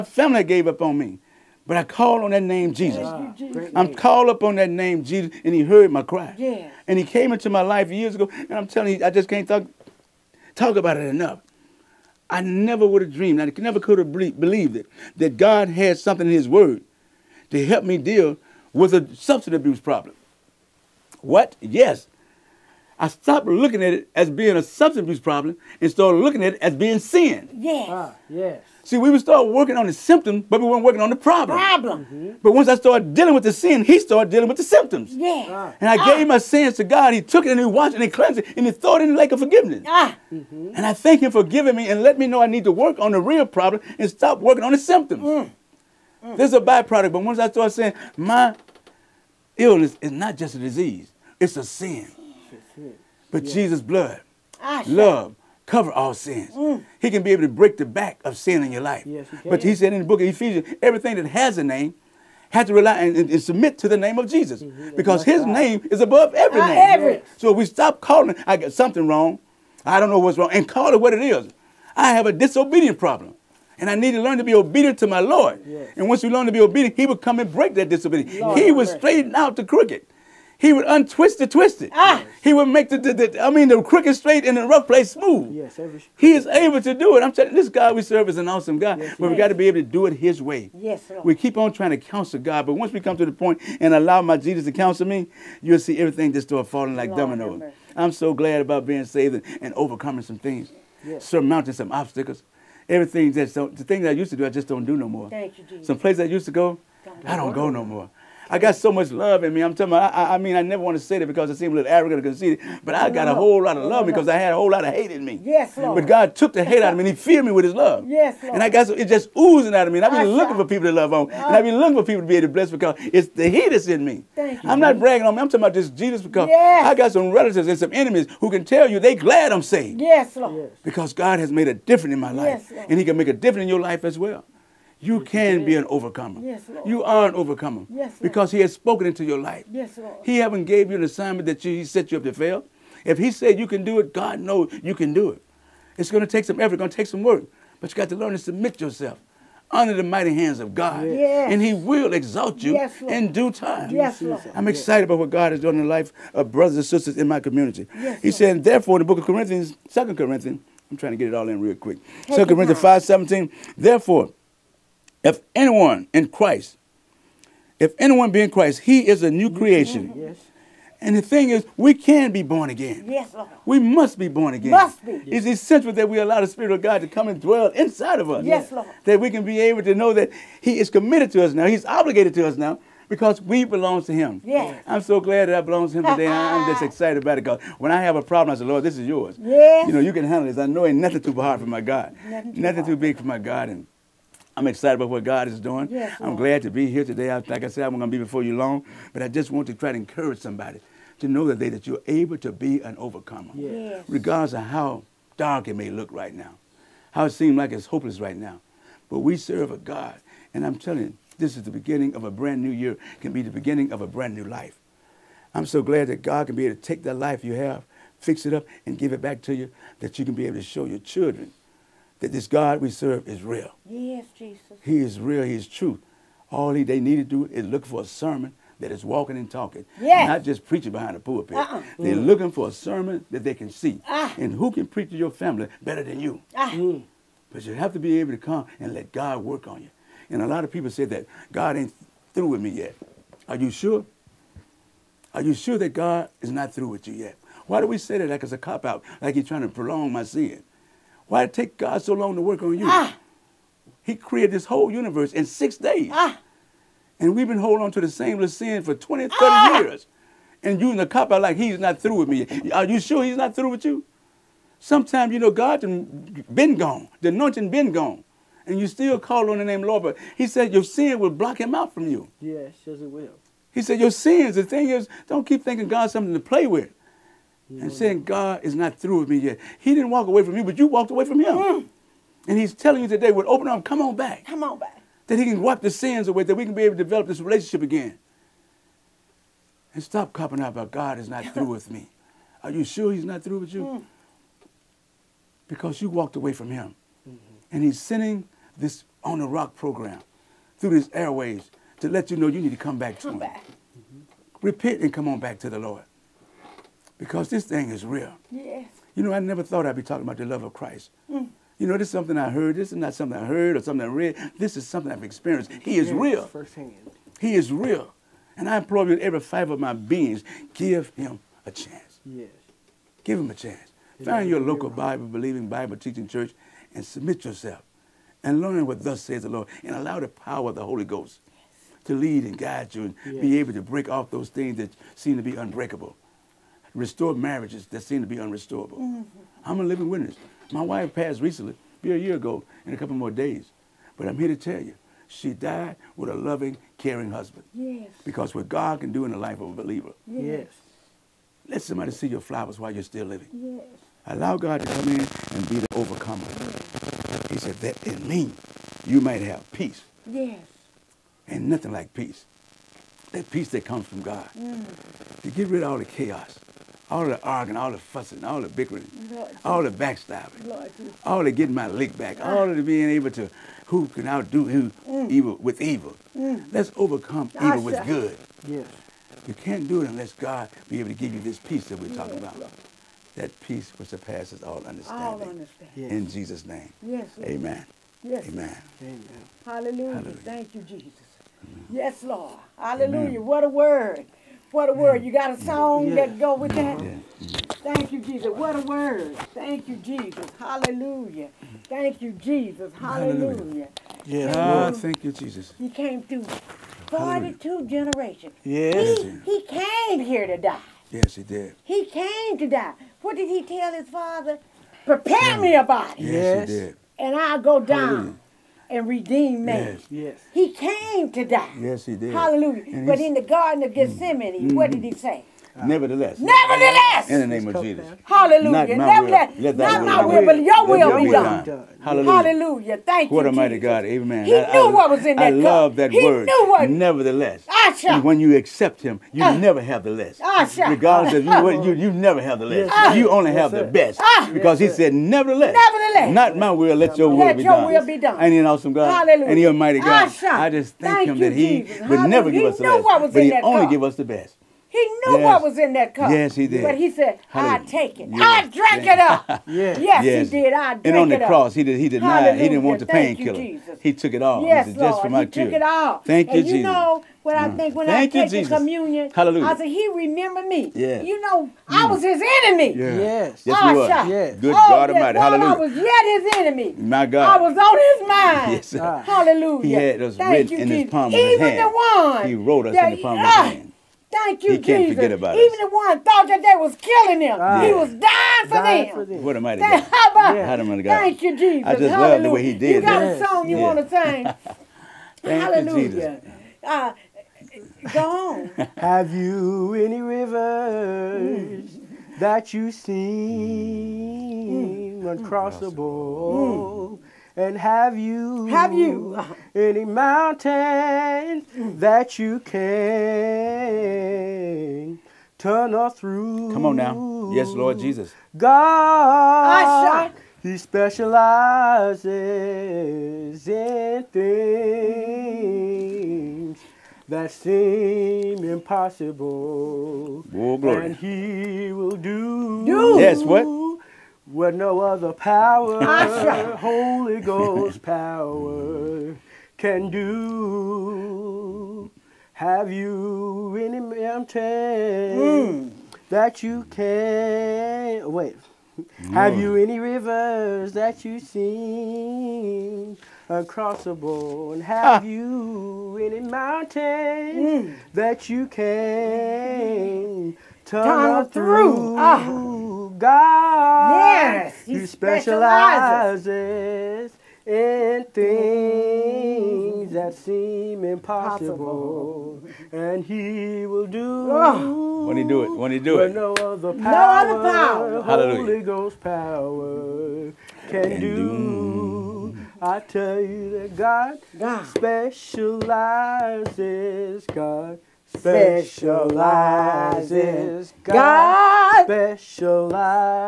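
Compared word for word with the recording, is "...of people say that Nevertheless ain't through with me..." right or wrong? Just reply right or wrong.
wrong.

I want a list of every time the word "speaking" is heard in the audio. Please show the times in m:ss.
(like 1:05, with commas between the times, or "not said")
not said.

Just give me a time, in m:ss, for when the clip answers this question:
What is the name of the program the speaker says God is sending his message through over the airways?
4:59.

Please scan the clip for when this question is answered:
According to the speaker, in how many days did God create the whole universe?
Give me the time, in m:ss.
4:15.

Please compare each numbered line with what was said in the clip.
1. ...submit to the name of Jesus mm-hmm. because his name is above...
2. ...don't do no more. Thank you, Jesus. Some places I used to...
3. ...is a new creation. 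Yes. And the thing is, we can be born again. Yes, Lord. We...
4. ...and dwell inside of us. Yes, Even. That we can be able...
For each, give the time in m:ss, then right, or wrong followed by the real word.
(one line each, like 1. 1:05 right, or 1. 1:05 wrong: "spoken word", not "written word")
1. 1:03 right
2. 1:44 right
3. 2:49 right
4. 2:57 wrong: "Lord", not "Even".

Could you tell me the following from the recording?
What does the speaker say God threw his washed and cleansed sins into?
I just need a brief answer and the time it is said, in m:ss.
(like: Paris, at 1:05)
The lake of forgiveness, at 0:39.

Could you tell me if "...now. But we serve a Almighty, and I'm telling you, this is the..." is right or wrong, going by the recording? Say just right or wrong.
wrong.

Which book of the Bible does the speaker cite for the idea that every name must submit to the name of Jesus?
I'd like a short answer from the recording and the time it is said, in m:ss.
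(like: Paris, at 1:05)
Ephesians, at 1:00.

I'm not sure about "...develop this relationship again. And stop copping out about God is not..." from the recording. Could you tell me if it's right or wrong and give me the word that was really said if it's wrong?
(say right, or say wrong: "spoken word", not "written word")
right.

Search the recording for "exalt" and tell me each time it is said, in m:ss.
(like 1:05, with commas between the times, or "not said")
2:32.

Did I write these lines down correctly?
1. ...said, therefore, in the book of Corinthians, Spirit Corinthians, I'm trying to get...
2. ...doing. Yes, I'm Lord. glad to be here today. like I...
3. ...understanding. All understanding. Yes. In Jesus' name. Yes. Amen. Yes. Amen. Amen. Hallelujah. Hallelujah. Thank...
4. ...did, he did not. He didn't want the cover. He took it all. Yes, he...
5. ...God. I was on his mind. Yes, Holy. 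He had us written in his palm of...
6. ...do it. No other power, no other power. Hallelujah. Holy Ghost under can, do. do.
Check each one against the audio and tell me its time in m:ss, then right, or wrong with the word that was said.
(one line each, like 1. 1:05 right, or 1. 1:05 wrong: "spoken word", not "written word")
1. 2:38 wrong: "Second", not "Spirit"
2. 3:15 right
3. 6:24 right
4. 7:41 wrong: "painkiller", not "cover"
5. 7:57 wrong: "Hallelujah", not "Holy"
6. 9:35 wrong: "power", not "under".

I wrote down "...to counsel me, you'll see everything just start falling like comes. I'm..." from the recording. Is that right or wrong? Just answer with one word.
wrong.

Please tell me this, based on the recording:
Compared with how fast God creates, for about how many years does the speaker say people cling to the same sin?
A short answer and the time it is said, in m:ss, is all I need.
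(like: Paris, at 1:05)
20 to 30 years, at 4:18.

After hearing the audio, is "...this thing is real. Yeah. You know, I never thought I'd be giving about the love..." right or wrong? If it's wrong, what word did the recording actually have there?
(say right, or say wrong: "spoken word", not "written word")
wrong: "talking", not "giving".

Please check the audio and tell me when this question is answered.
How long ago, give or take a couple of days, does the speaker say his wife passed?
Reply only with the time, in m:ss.
5:42.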